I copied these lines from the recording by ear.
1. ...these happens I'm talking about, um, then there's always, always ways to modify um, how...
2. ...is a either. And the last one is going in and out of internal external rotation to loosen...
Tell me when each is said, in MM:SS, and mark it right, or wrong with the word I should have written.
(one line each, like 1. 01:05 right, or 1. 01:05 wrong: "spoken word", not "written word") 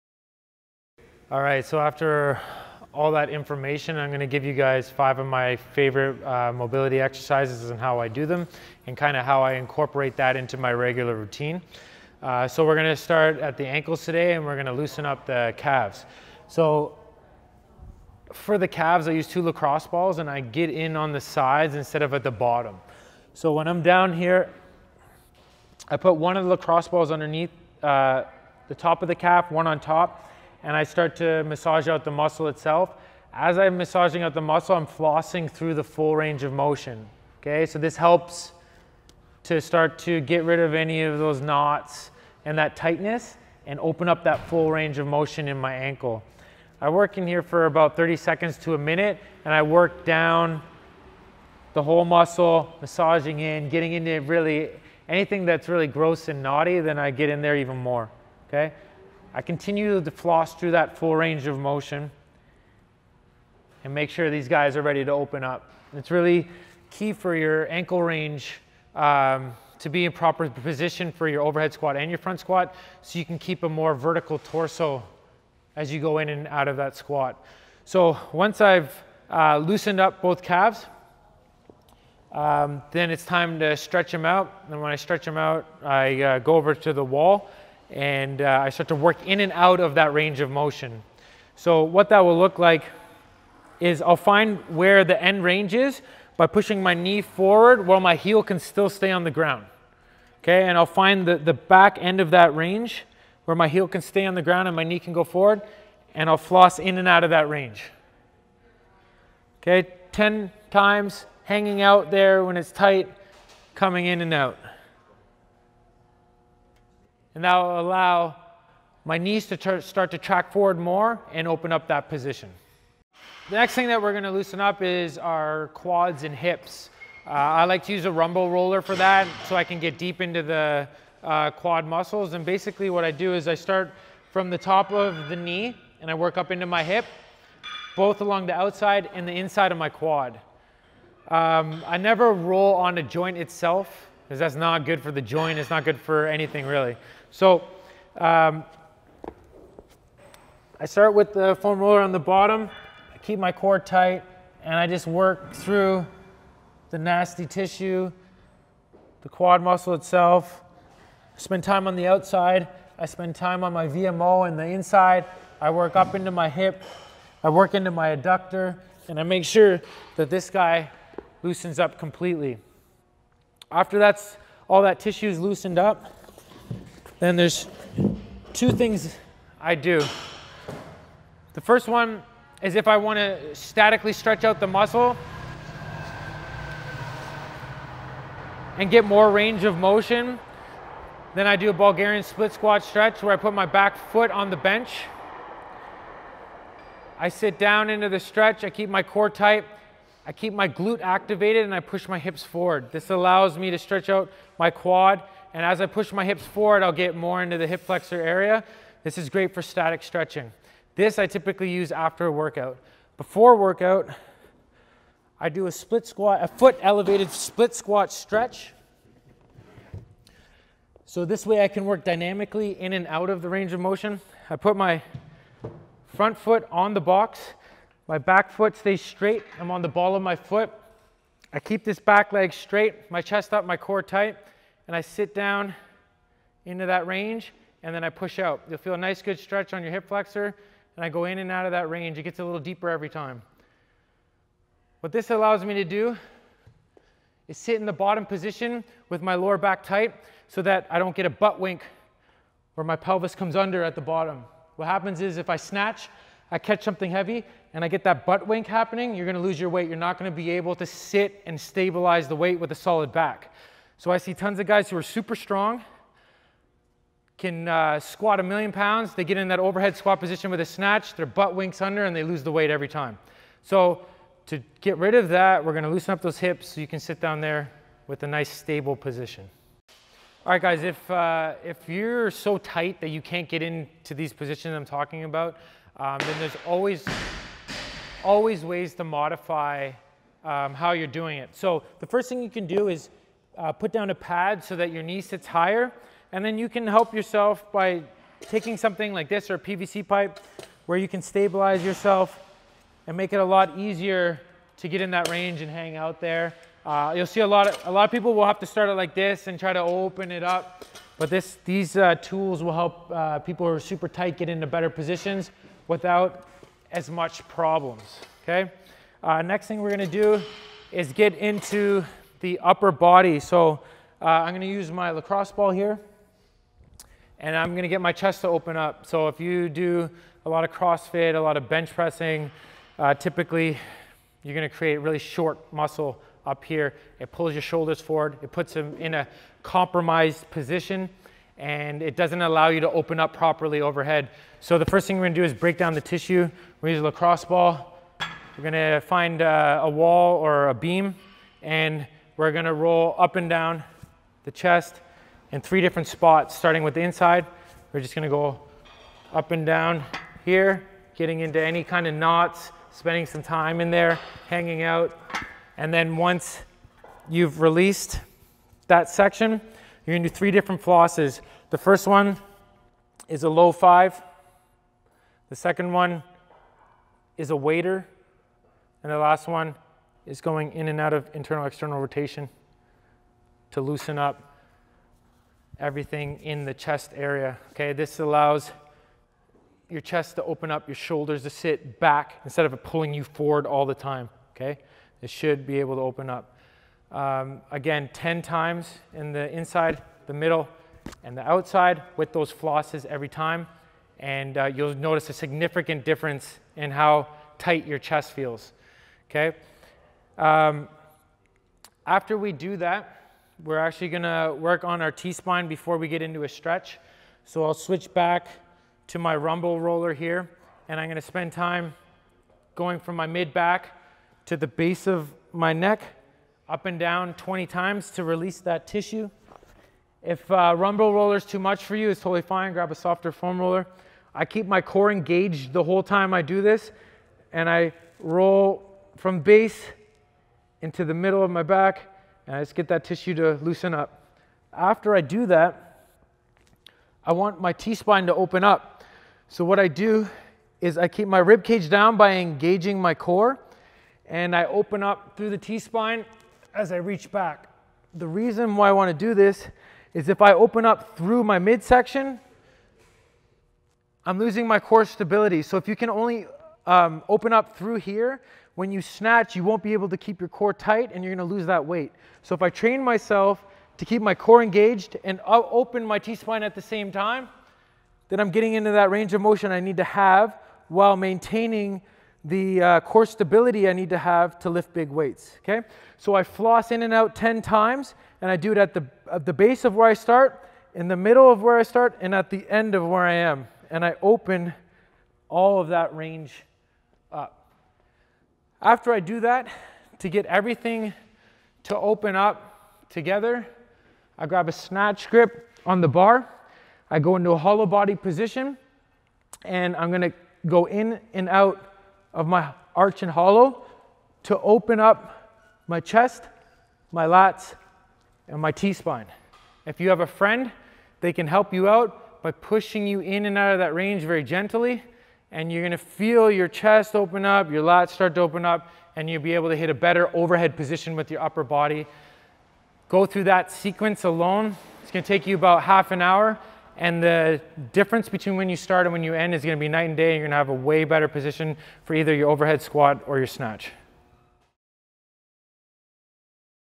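1. 04:44 wrong: "positions", not "happens"
2. 06:17 wrong: "waiter", not "either".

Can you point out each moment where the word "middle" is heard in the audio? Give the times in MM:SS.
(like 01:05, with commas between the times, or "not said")
06:40, 07:21, 08:11.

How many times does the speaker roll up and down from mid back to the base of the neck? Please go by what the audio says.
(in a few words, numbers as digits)
20.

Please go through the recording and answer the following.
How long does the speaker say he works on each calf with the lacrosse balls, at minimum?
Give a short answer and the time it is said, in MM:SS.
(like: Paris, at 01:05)
30 seconds, at 00:47.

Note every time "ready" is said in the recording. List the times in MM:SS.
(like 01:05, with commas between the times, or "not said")
01:04.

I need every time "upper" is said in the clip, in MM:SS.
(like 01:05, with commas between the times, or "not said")
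05:22, 08:51.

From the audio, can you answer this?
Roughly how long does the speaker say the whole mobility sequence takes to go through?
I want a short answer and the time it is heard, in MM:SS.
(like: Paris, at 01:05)
half an hour, at 08:55.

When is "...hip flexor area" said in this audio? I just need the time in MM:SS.
03:27.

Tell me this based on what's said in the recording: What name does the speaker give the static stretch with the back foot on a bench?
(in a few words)
Bulgarian split squat stretch.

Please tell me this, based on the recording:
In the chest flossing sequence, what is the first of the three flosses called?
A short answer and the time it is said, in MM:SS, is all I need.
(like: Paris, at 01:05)
low five, at 06:13.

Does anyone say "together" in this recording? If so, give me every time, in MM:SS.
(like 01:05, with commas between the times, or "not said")
08:23.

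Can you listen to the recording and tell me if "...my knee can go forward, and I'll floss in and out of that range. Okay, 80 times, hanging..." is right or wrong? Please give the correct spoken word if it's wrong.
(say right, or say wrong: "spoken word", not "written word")
wrong: "10", not "80".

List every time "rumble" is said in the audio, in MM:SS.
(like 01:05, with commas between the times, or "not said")
02:08, 06:59, 07:10.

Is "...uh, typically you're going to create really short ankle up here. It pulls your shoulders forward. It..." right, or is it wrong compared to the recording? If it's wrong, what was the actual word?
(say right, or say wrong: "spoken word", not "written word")
wrong: "muscle", not "ankle".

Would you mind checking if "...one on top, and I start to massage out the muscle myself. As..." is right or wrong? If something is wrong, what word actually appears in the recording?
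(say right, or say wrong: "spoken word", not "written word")
wrong: "itself", not "myself".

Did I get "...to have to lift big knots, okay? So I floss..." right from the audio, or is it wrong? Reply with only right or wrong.
wrong.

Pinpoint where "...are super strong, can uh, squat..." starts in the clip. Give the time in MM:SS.
04:24.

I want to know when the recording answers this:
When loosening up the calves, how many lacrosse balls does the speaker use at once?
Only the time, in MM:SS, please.
00:19.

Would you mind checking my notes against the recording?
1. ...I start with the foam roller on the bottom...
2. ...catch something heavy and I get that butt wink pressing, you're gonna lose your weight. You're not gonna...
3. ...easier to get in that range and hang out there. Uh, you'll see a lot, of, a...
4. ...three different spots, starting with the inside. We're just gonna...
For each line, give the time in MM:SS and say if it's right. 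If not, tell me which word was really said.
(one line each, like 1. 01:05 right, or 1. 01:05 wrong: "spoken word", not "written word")
1. 02:30 right
2. 04:16 wrong: "happening", not "pressing"
3. 05:03 right
4. 05:55 right.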